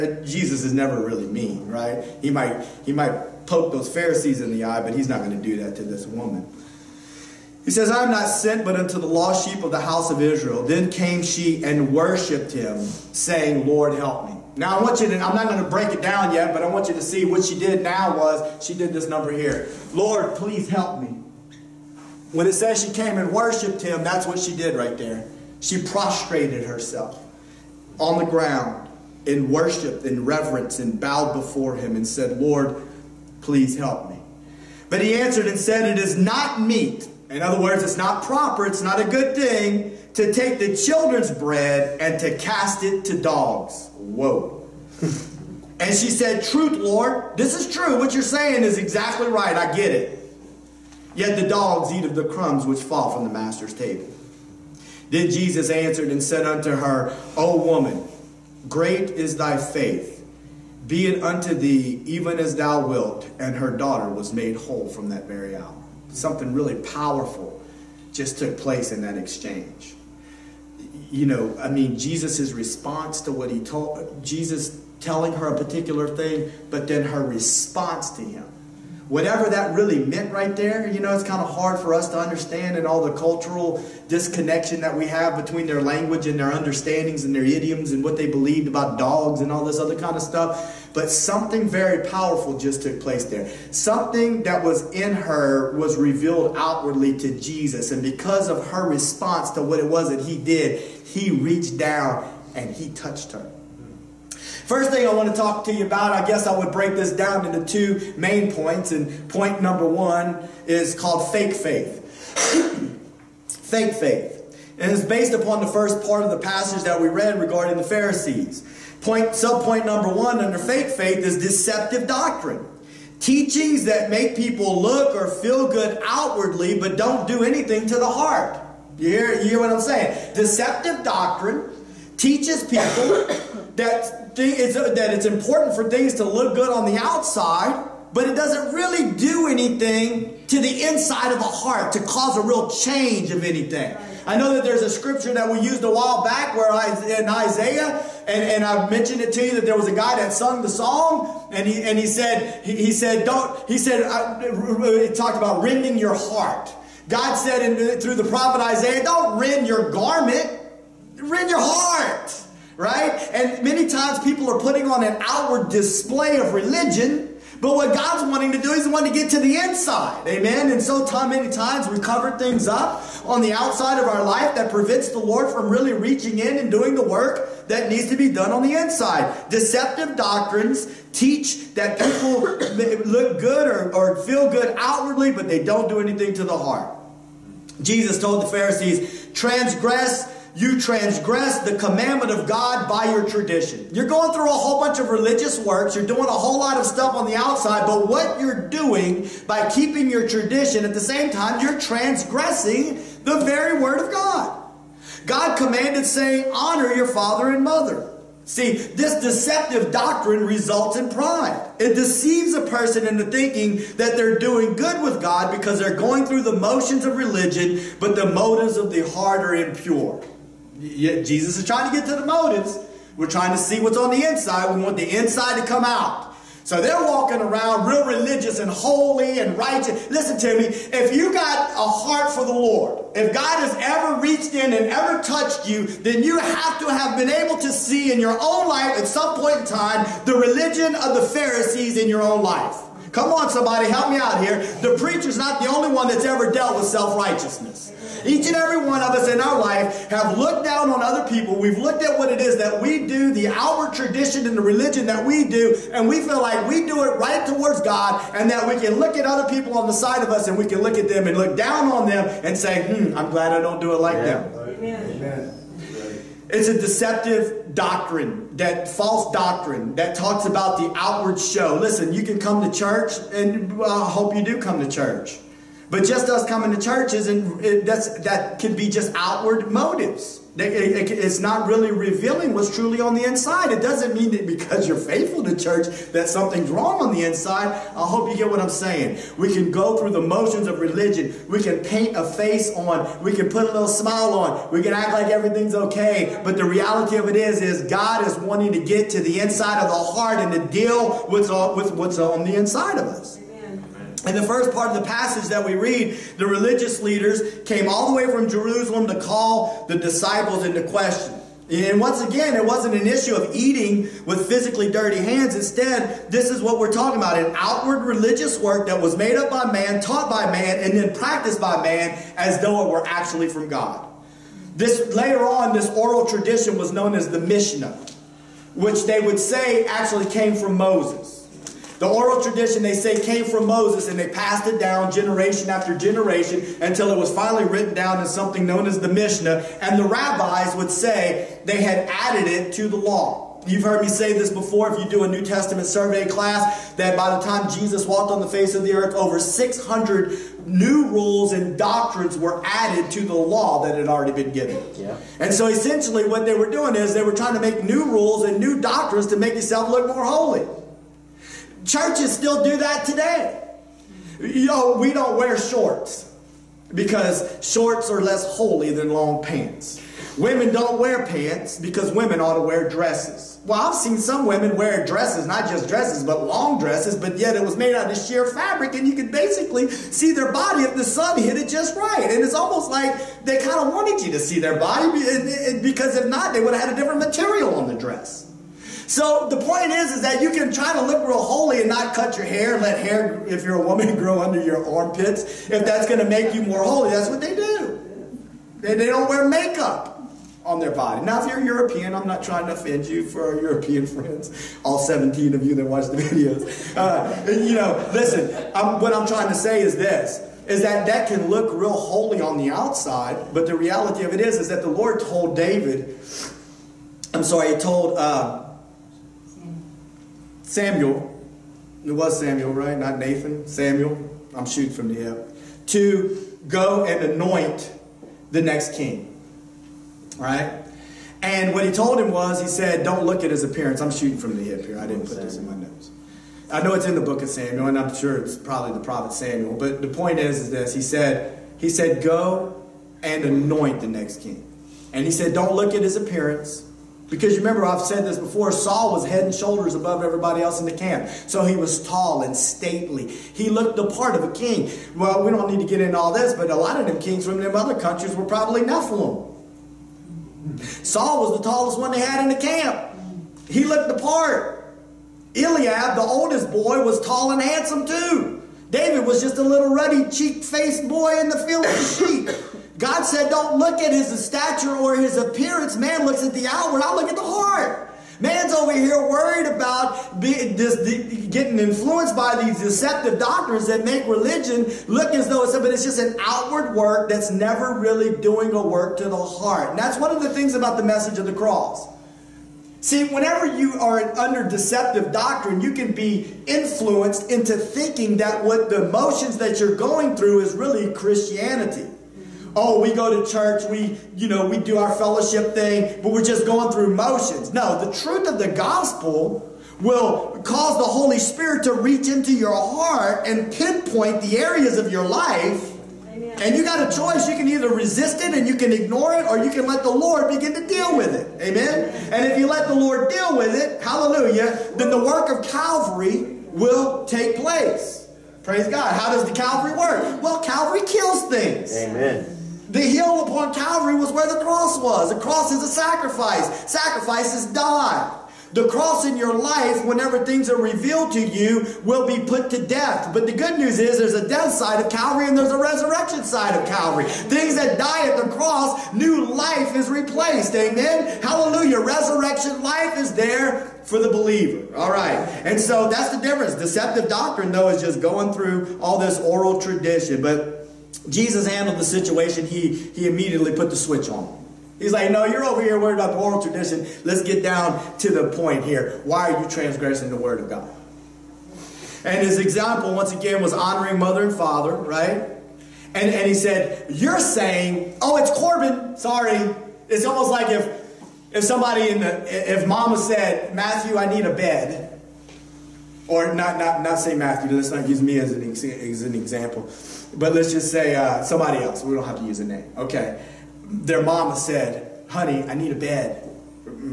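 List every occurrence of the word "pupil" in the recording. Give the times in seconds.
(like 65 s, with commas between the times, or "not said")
not said.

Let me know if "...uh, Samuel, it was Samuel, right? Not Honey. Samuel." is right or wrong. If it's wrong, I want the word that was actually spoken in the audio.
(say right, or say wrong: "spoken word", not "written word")
wrong: "Nathan", not "Honey".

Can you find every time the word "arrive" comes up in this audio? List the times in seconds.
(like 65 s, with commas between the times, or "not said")
not said.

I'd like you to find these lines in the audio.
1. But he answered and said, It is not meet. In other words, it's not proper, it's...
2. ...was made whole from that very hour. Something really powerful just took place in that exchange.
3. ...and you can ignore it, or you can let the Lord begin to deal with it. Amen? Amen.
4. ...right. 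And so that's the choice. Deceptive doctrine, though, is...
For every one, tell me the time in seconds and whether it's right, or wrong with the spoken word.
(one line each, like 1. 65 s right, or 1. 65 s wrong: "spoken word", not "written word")
1. 34 s right
2. 64 s right
3. 518 s right
4. 555 s wrong: "difference", not "choice".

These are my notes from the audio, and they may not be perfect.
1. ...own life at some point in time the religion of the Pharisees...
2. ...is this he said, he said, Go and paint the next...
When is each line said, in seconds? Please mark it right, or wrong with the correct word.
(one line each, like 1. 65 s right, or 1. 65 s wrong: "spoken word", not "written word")
1. 238 s right
2. 440 s wrong: "anoint", not "paint".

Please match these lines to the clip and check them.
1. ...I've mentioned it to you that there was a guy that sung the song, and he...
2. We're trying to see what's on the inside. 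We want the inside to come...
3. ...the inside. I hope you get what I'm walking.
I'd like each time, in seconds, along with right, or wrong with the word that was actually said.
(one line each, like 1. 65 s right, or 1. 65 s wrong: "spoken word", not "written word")
1. 148 s right
2. 223 s right
3. 287 s wrong: "saying", not "walking".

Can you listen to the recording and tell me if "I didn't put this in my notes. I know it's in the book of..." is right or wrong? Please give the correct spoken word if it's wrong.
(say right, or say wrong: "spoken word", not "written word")
right.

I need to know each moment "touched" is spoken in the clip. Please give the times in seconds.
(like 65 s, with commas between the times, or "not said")
102 s, 235 s.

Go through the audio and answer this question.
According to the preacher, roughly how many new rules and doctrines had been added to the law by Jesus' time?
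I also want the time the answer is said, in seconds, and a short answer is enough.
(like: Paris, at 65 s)
over 600, at 349 s.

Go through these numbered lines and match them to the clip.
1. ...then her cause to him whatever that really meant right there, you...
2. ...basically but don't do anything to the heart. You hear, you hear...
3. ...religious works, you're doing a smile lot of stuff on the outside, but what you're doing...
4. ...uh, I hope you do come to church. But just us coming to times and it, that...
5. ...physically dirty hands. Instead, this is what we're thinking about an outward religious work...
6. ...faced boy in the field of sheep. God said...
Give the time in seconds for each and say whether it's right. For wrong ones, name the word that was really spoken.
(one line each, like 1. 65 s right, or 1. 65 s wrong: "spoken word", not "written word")
1. 76 s wrong: "response", not "cause"
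2. 126 s wrong: "outwardly", not "basically"
3. 195 s wrong: "whole", not "smile"
4. 273 s wrong: "churches", not "times"
5. 314 s wrong: "talking", not "thinking"
6. 470 s right.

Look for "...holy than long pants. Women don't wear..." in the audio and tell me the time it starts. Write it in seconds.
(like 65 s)
368 s.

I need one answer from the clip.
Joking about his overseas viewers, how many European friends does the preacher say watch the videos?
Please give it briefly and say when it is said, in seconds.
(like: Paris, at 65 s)
17, at 404 s.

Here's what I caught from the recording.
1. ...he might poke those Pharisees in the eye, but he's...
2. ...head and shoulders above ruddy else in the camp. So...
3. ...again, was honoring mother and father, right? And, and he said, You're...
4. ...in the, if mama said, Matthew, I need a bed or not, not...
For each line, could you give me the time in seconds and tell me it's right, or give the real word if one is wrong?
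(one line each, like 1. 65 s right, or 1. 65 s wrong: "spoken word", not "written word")
1. 2 s right
2. 449 s wrong: "everybody", not "ruddy"
3. 573 s right
4. 582 s right.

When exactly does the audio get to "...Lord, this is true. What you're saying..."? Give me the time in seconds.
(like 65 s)
46 s.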